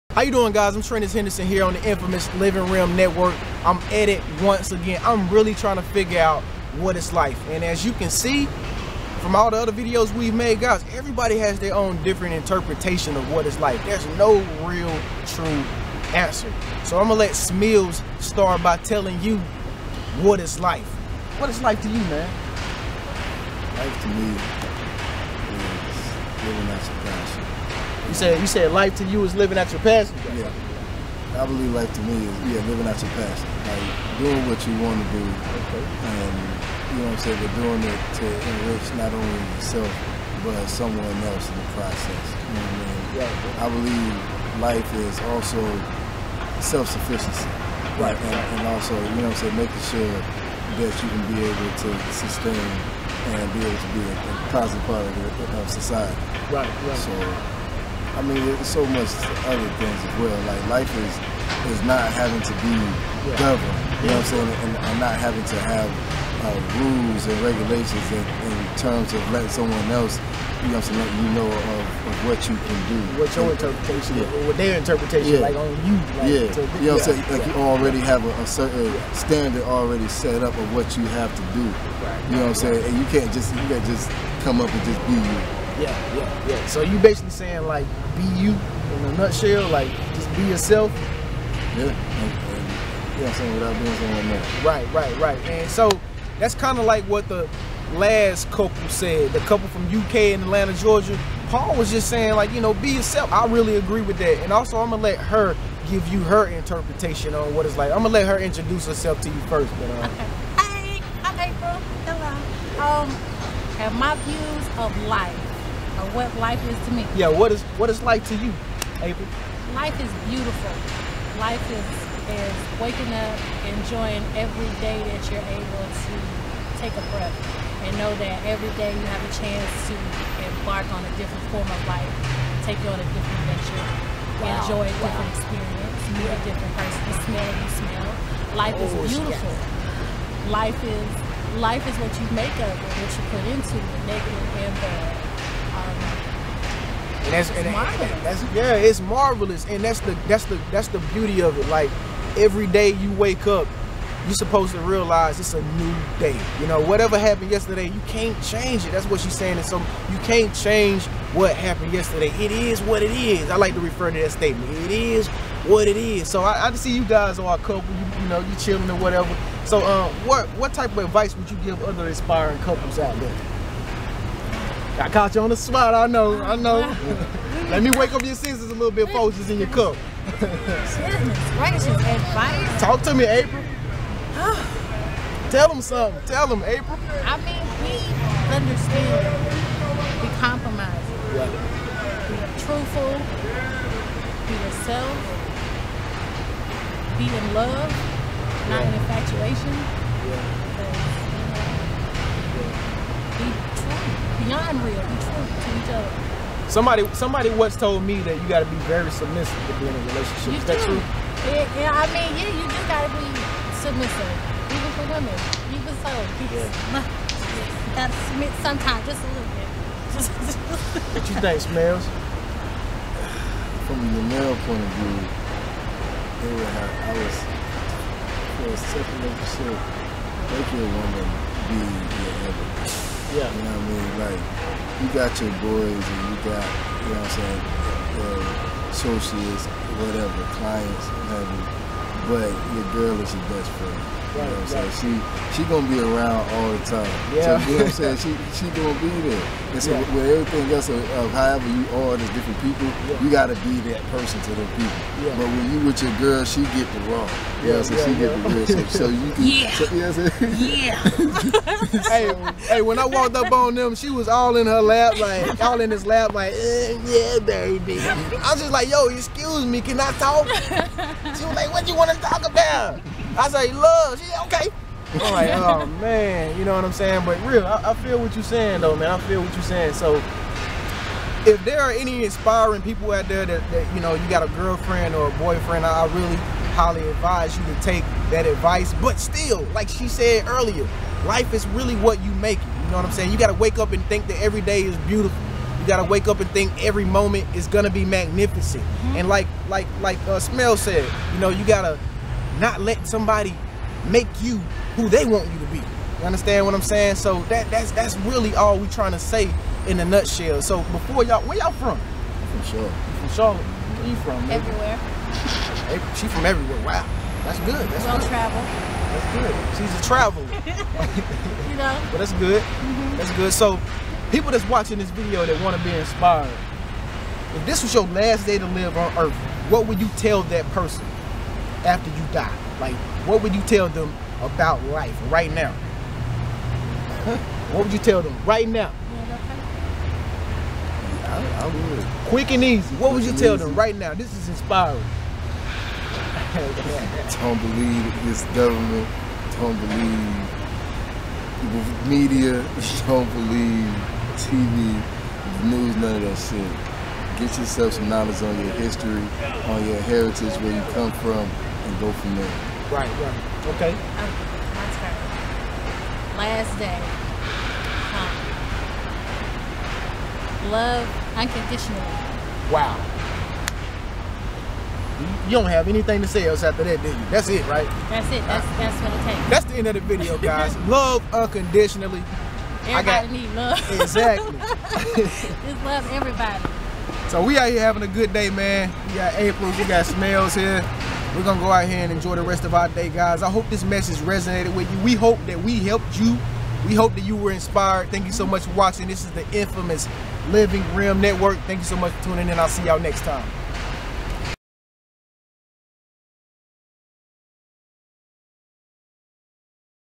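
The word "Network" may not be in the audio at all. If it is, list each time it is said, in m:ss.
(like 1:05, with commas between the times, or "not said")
0:02, 6:41.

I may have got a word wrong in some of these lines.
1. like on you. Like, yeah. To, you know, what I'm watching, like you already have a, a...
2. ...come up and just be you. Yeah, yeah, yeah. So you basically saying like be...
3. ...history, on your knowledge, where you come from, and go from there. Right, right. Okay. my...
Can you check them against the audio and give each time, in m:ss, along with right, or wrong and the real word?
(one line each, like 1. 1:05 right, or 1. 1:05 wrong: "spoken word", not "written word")
1. 1:15 wrong: "saying", not "watching"
2. 1:24 right
3. 5:58 wrong: "heritage", not "knowledge".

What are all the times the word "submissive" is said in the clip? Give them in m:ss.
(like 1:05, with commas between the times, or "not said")
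3:29, 3:33.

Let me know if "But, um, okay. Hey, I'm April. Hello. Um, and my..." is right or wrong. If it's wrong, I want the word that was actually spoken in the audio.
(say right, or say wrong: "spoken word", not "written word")
right.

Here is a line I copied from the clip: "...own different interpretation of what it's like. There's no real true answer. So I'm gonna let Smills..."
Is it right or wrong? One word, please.
right.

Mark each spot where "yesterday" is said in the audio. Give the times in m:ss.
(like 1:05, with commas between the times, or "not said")
2:37, 2:41.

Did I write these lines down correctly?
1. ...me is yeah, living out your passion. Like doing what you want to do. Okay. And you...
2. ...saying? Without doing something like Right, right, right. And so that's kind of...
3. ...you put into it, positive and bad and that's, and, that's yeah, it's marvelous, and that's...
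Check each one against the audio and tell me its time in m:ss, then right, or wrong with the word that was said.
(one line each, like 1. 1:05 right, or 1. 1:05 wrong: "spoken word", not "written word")
1. 0:32 right
2. 1:33 right
3. 2:23 wrong: "negative", not "positive".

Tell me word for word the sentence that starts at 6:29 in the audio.
We got April, we got Smills here.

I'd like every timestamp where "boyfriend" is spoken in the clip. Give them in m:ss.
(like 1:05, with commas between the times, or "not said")
4:45.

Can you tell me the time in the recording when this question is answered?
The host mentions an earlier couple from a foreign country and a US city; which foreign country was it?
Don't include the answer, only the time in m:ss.
1:39.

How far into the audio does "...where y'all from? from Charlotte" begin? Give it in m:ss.
5:11.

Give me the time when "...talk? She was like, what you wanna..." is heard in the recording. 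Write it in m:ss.
4:30.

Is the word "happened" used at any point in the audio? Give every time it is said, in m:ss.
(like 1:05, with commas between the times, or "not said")
2:37, 2:41.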